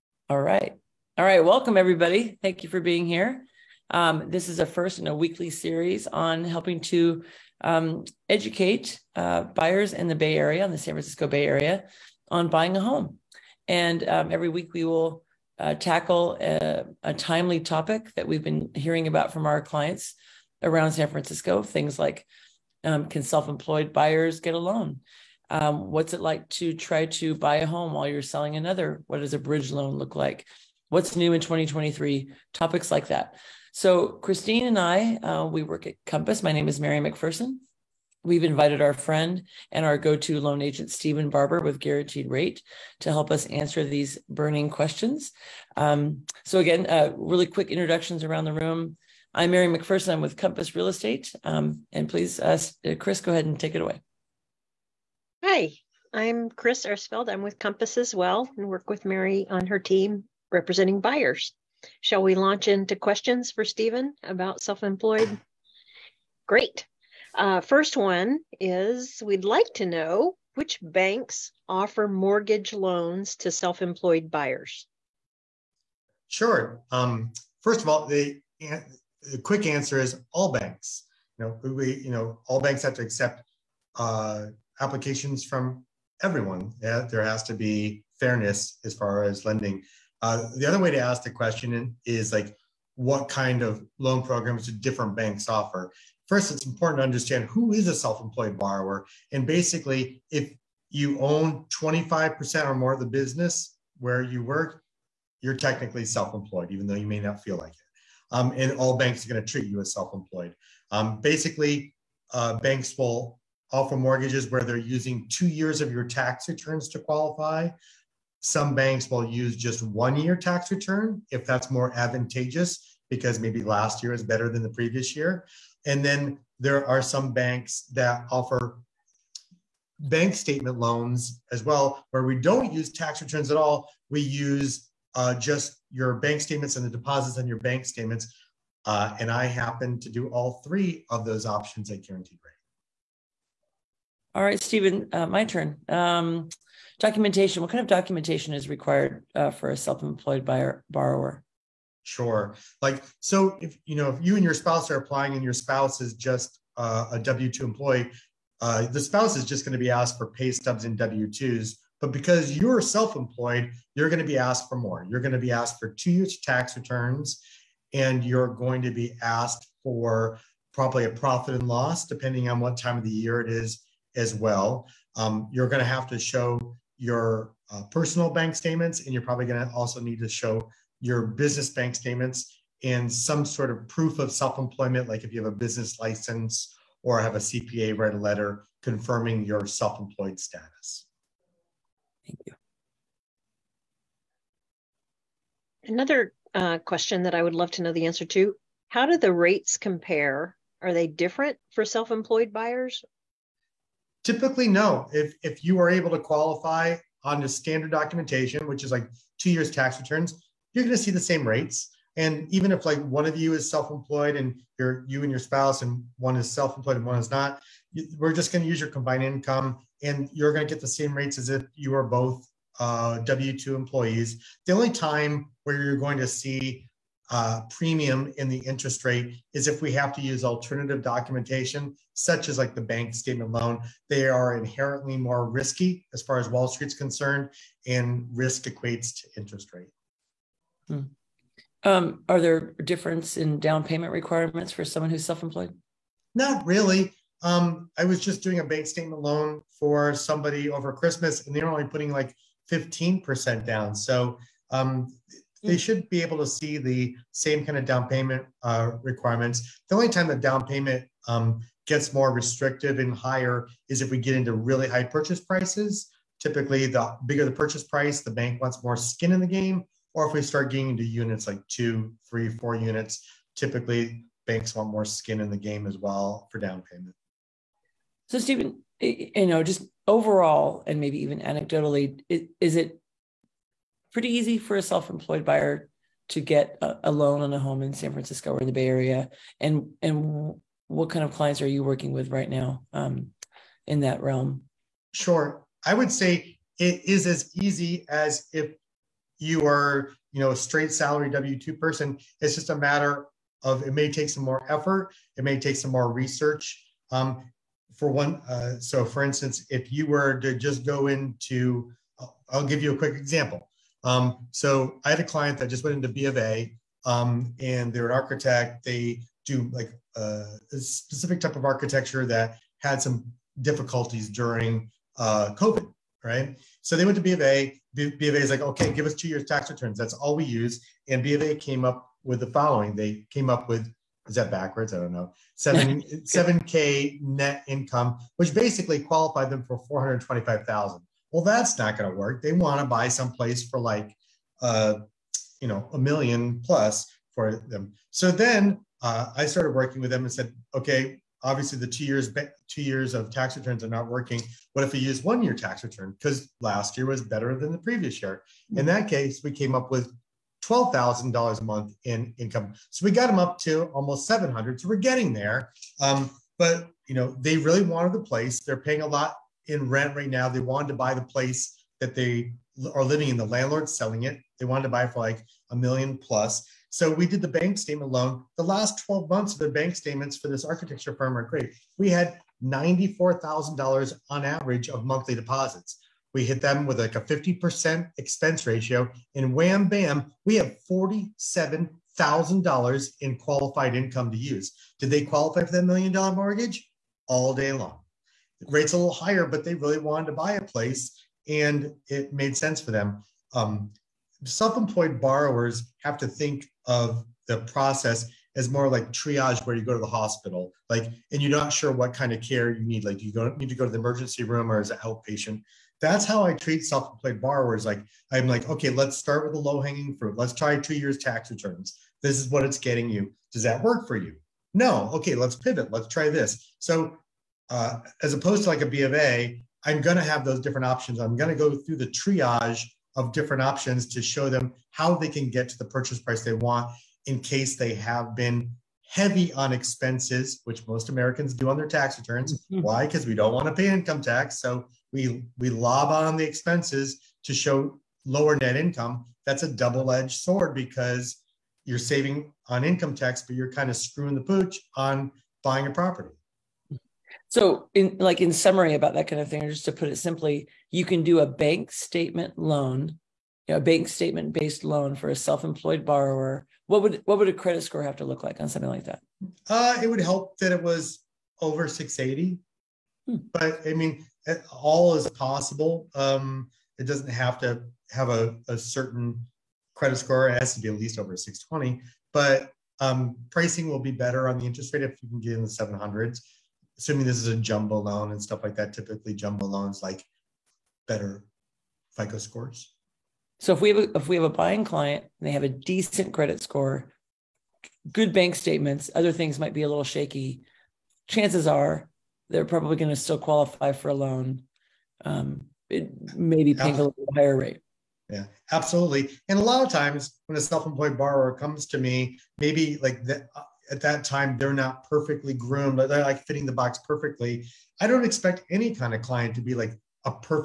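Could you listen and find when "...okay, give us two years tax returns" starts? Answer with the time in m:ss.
5:28.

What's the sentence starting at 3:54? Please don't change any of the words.
They are inherently more risky as far as Wall Street's concerned, and risk equates to interest rate.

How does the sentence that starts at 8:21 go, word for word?
Chances are they're probably going to still qualify for a loan.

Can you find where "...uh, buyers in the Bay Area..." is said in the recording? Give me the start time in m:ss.
0:09.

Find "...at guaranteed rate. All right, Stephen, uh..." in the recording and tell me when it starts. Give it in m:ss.
2:21.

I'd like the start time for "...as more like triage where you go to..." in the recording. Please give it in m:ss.
6:48.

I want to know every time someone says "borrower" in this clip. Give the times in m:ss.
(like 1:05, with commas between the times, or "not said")
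1:38, 2:30, 6:45, 6:57, 7:46, 8:31.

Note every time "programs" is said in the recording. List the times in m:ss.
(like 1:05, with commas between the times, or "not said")
1:34.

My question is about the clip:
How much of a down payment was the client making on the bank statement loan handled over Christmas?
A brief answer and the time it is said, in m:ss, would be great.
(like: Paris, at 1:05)
15%, at 4:12.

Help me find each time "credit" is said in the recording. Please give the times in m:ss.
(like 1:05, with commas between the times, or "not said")
7:47, 7:59, 8:16.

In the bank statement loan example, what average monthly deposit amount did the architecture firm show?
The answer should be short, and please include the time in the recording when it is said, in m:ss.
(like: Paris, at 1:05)
$94,000, at 6:22.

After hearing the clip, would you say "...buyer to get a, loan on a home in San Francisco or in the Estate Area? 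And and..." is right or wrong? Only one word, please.
wrong.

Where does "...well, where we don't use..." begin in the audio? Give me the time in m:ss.
2:11.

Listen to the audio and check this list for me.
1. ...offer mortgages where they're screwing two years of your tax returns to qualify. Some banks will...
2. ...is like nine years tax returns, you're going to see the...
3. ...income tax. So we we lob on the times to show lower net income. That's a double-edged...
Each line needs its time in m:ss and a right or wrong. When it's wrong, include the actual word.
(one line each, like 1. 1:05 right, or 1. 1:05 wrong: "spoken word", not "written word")
1. 1:53 wrong: "using", not "screwing"
2. 3:28 wrong: "two", not "nine"
3. 7:23 wrong: "expenses", not "times".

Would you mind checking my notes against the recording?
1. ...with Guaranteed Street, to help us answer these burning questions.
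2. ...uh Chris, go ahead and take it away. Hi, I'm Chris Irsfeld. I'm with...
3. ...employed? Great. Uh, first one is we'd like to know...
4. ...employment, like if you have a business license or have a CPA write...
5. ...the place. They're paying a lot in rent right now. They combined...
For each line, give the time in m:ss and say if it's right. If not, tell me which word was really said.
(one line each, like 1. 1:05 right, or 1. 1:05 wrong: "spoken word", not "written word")
1. 0:41 wrong: "Rate", not "Street"
2. 0:52 right
3. 1:04 right
4. 3:04 right
5. 6:08 wrong: "wanted", not "combined".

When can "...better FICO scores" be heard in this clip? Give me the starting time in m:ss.
8:11.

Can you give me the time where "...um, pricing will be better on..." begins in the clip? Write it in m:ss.
8:03.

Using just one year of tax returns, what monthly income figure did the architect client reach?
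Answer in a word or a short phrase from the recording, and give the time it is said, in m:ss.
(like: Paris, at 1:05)
$12,000, at 6:00.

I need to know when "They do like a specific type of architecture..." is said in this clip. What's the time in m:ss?
5:18.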